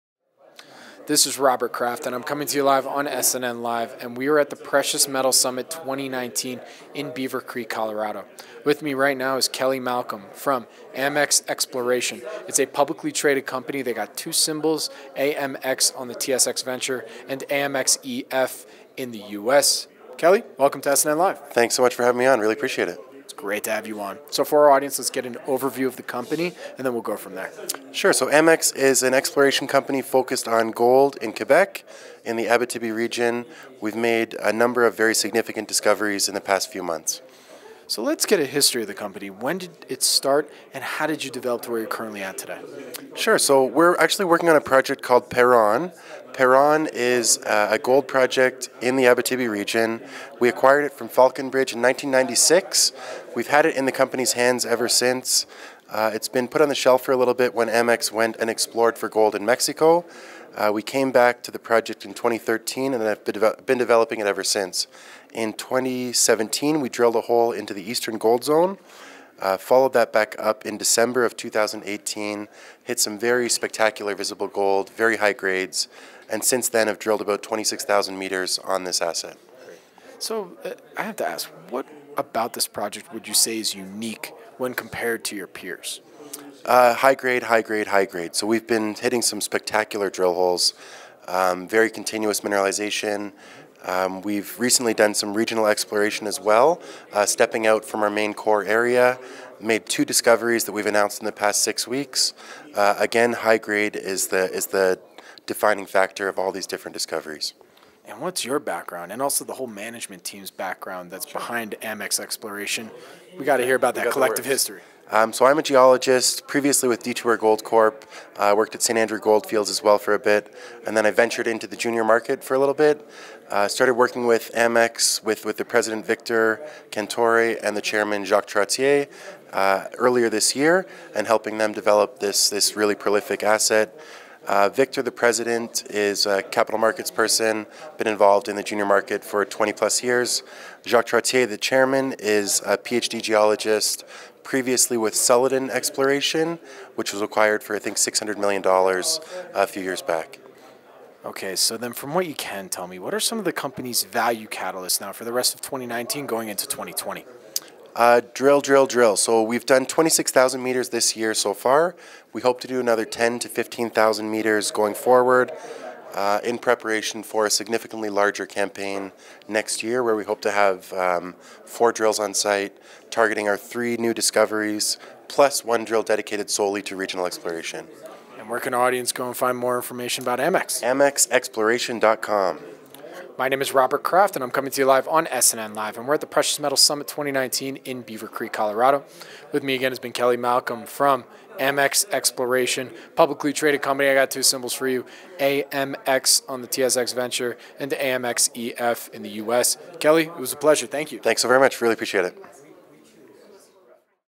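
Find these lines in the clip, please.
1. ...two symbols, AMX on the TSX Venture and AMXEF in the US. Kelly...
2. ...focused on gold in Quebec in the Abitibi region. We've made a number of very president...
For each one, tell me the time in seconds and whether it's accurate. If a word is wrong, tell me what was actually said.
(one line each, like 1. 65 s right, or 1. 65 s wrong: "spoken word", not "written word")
1. 14 s right
2. 30 s wrong: "significant", not "president".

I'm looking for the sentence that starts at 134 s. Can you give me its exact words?
Uh, Victor, the president, is a capital markets person, been involved in the junior market for 20 plus years.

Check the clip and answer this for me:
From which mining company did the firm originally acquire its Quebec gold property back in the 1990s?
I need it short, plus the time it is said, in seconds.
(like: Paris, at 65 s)
Falconbridge, at 51 s.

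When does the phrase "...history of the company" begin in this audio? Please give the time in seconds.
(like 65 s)
38 s.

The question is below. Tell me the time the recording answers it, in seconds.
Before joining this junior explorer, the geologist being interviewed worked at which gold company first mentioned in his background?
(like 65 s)
117 s.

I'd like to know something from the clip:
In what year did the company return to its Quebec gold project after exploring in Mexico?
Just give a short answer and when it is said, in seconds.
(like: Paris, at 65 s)
2013, at 62 s.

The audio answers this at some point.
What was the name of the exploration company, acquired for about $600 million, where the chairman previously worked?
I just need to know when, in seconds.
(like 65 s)
145 s.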